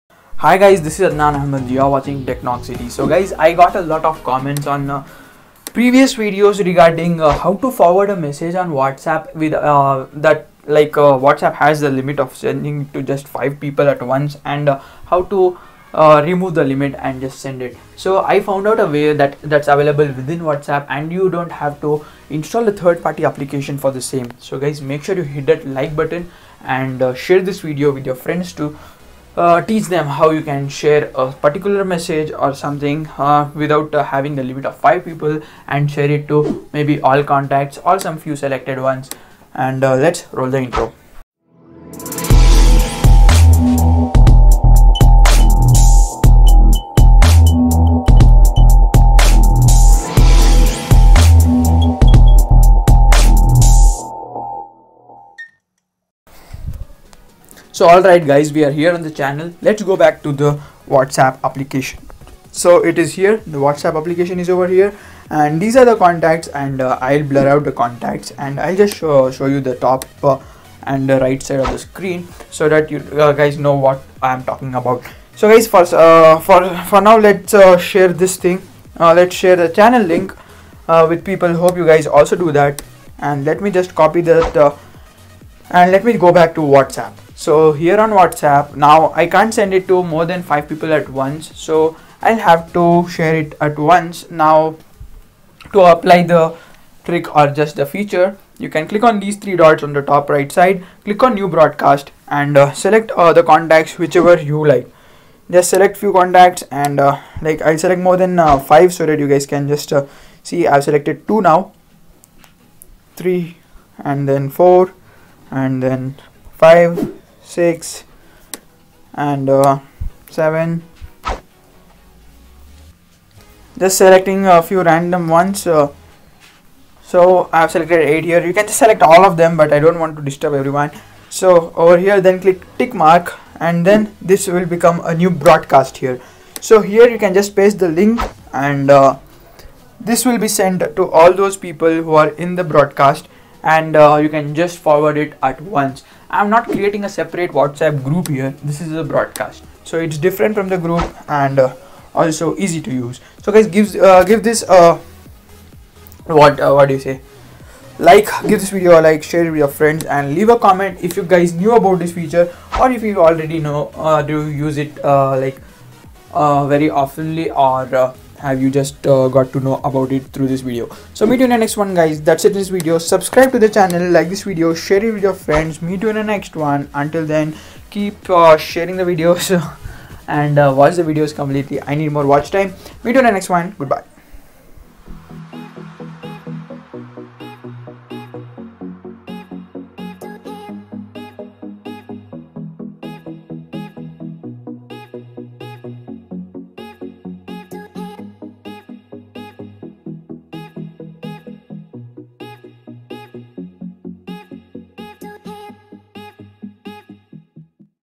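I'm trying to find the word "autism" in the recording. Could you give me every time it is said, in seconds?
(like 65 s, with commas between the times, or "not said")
not said.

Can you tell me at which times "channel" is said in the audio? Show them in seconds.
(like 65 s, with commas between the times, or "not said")
59 s, 79 s, 173 s.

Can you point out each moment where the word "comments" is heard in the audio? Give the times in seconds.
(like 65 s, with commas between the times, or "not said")
4 s, 160 s.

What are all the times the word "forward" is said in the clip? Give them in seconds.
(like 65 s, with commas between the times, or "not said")
7 s, 144 s.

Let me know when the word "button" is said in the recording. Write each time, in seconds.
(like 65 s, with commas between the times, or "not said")
25 s.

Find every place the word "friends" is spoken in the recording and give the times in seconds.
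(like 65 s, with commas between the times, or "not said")
28 s, 159 s, 175 s.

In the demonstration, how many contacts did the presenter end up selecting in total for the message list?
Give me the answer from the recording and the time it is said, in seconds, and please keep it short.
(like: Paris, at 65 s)
8, at 127 s.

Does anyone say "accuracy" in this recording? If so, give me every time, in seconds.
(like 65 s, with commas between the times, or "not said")
not said.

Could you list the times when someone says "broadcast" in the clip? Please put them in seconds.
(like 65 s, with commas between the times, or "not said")
101 s, 135 s, 142 s, 149 s.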